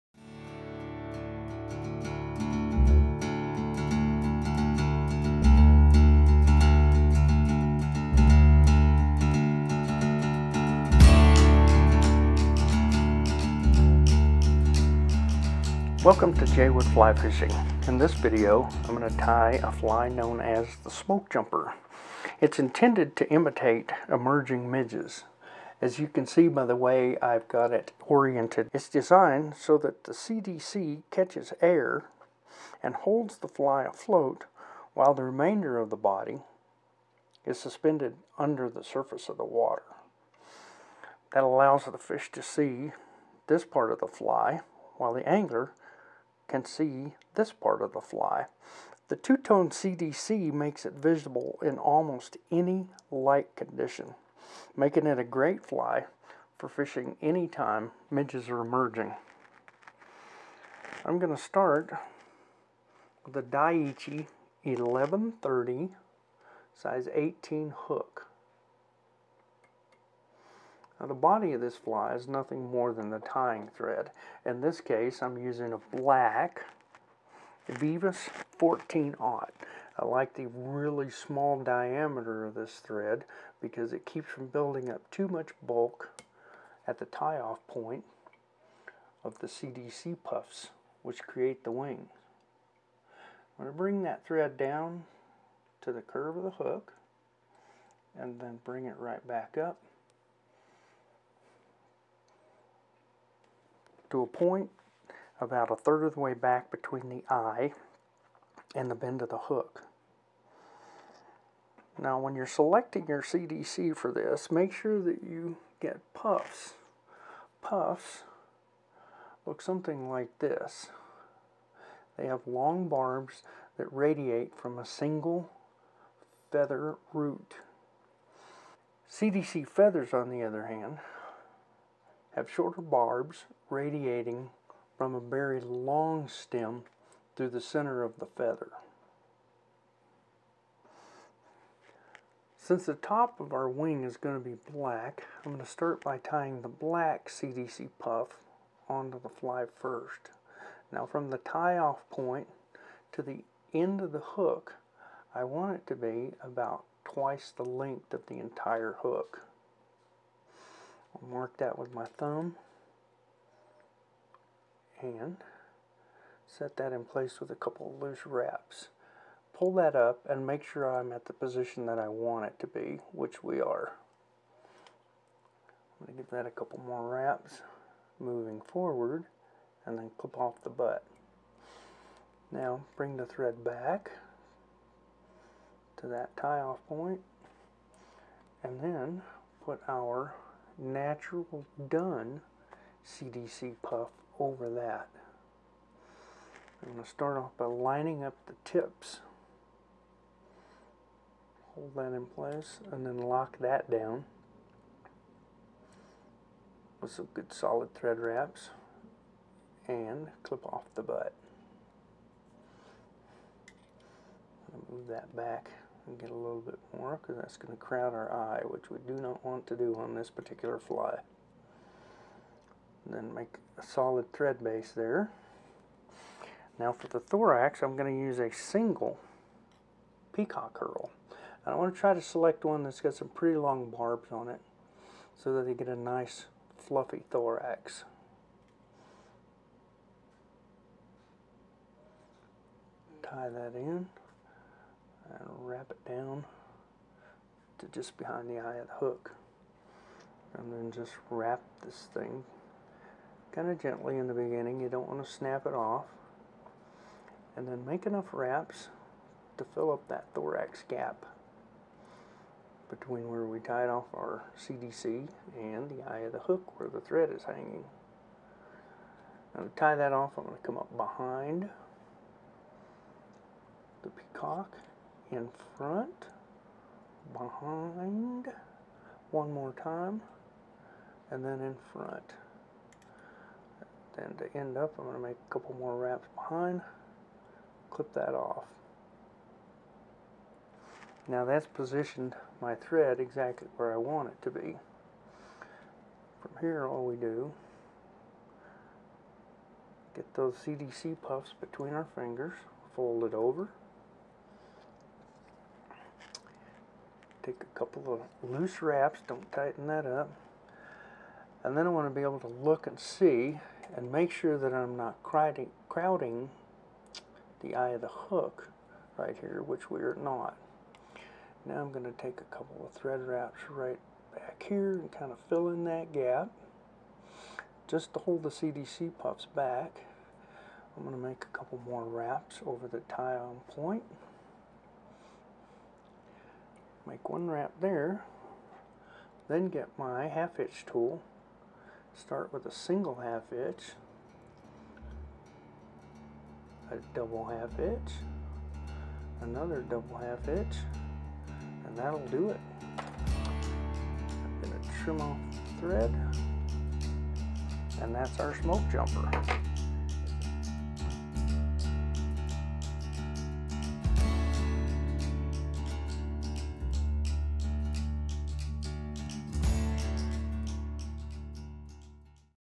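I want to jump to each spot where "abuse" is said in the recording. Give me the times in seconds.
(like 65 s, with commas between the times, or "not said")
not said.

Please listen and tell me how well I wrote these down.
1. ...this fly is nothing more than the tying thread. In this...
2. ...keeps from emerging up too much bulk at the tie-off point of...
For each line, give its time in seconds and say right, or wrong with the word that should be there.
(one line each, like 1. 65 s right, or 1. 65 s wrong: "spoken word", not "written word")
1. 71 s right
2. 84 s wrong: "building", not "emerging".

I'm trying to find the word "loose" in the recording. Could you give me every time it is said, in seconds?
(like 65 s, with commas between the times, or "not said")
167 s, 308 s.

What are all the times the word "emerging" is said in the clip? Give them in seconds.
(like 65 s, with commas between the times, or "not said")
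24 s, 58 s.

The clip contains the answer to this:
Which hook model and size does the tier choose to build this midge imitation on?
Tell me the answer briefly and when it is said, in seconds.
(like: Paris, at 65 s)
Daiichi 1130 size 18, at 63 s.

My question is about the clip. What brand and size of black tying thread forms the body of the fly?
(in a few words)
Veevus 14/0.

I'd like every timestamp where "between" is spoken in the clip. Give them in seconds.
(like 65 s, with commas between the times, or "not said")
106 s, 262 s, 301 s.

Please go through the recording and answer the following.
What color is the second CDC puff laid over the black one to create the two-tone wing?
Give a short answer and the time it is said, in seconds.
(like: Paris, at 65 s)
Natural dun, at 190 s.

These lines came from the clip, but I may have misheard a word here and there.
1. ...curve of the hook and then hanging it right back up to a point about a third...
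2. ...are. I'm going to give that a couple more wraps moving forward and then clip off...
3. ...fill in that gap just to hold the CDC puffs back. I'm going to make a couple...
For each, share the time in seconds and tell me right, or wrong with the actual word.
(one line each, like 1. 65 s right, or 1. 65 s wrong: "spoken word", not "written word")
1. 96 s wrong: "bring", not "hanging"
2. 173 s right
3. 325 s right.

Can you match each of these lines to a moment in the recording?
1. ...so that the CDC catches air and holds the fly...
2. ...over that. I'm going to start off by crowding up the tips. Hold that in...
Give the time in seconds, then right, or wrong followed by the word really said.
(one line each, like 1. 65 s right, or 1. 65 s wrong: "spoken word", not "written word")
1. 29 s right
2. 194 s wrong: "lining", not "crowding".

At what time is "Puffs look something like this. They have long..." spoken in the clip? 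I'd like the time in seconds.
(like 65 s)
117 s.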